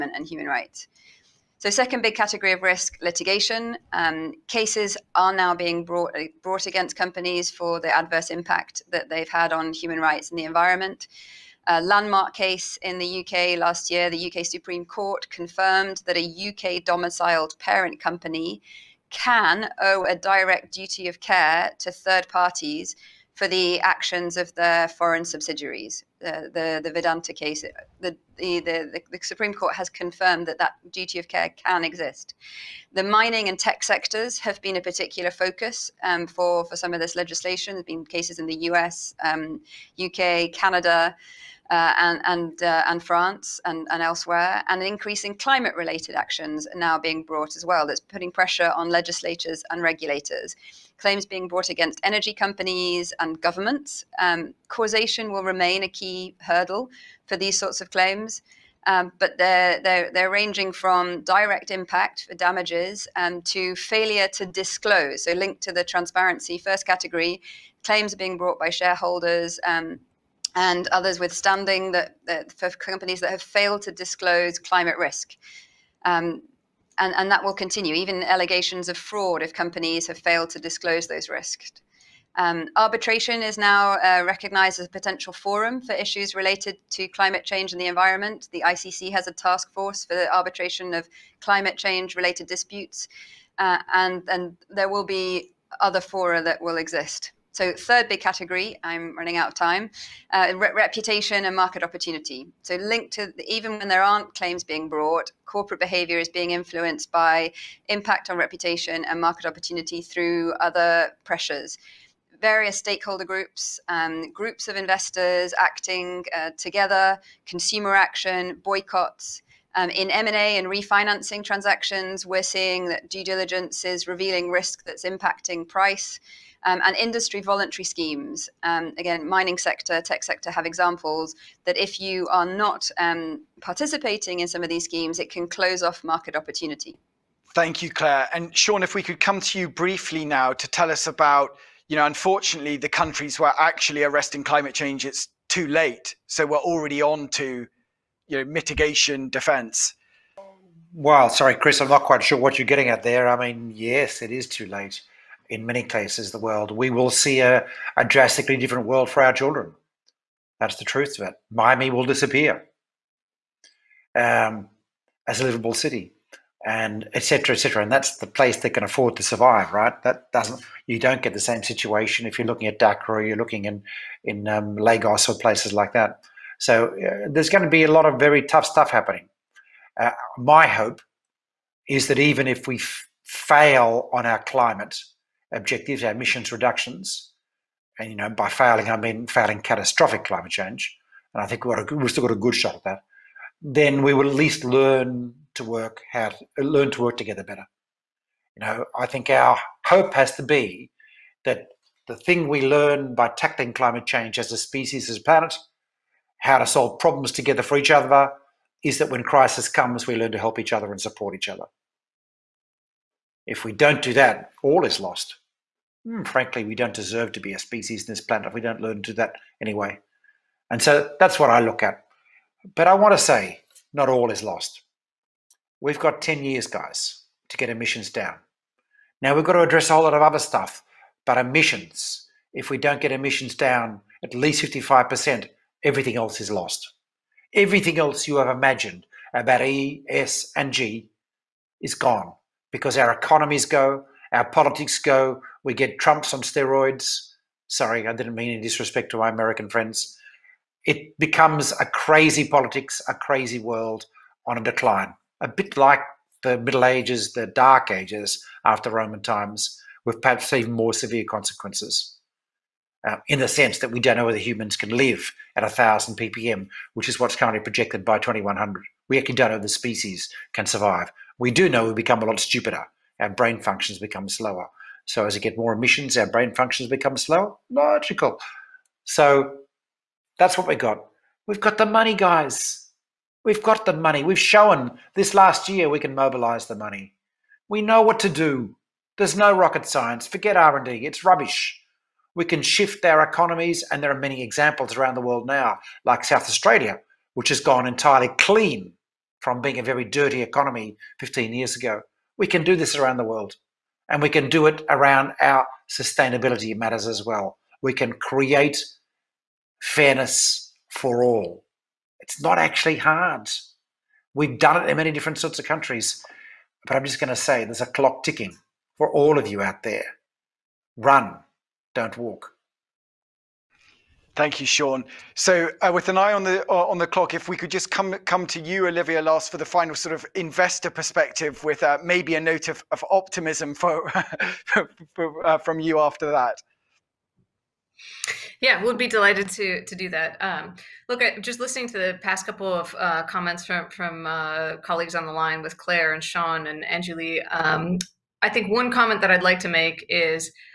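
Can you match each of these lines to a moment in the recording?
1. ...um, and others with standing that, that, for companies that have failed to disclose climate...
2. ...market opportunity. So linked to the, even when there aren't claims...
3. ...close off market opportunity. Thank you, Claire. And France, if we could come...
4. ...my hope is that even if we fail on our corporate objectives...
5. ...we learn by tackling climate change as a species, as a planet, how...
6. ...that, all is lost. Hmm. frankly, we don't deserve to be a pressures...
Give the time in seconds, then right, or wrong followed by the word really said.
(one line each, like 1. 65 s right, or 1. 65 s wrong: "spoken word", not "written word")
1. 69 s right
2. 101 s right
3. 135 s wrong: "Sean", not "France"
4. 180 s wrong: "climate", not "corporate"
5. 202 s right
6. 214 s wrong: "species", not "pressures".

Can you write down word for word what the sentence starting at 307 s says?
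We can create fairness for all.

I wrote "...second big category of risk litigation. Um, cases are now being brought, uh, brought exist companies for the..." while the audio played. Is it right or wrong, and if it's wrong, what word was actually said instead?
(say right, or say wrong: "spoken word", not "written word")
wrong: "against", not "exist".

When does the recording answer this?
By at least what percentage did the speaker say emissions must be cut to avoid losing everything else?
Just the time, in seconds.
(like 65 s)
234 s.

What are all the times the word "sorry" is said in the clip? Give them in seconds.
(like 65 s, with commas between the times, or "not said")
151 s, 247 s.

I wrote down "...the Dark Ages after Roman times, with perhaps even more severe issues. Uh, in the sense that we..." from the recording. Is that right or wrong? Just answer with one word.
wrong.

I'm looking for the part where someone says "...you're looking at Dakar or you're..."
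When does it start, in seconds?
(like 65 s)
172 s.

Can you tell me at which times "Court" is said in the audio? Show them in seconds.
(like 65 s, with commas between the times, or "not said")
14 s, 29 s.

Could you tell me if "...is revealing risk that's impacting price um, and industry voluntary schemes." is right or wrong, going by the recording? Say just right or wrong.
right.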